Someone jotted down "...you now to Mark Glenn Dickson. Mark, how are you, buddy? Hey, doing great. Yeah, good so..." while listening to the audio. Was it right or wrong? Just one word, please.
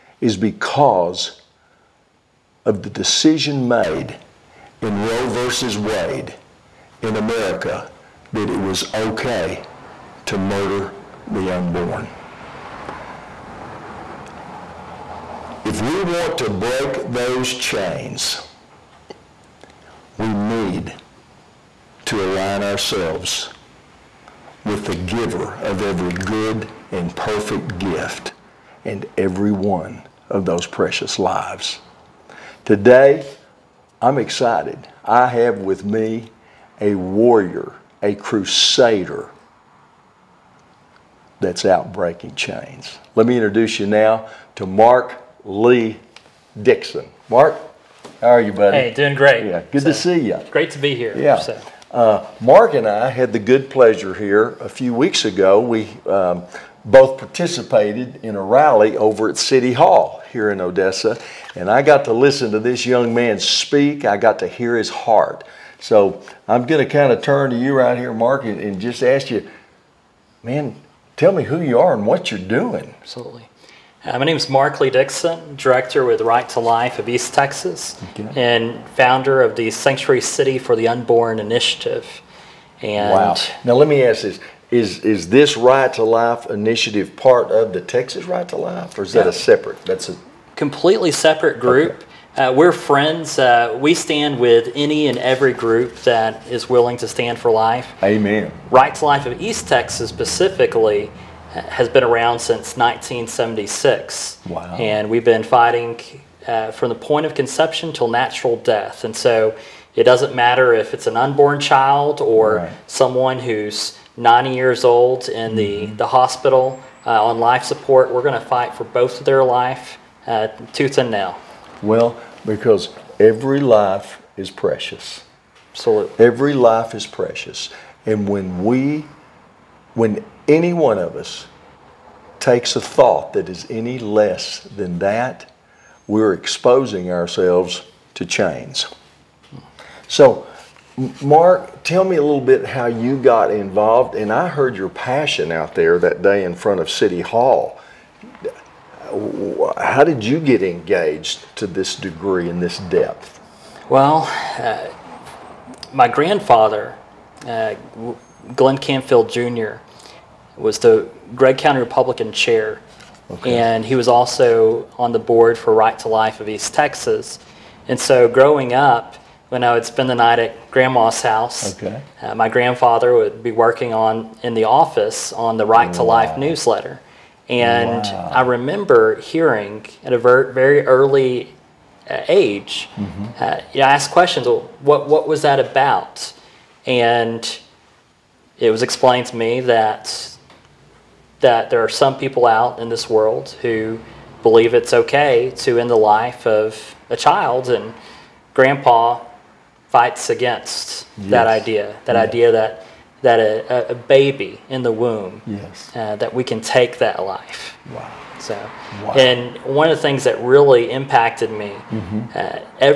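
wrong.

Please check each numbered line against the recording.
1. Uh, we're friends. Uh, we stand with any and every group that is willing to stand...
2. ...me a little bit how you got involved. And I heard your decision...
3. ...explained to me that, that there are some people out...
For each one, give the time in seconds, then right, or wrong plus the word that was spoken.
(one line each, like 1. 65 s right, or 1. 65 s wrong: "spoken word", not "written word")
1. 92 s right
2. 142 s wrong: "passion", not "decision"
3. 188 s right.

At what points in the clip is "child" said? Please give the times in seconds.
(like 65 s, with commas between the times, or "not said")
111 s, 197 s.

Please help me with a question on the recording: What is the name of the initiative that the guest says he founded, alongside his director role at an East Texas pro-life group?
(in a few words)
Sanctuary City for the Unborn Initiative.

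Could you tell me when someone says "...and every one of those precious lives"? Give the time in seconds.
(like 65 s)
28 s.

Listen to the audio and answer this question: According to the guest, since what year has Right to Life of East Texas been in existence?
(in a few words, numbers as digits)
1976.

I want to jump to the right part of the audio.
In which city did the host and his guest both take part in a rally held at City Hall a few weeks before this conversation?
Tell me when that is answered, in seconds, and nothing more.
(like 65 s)
60 s.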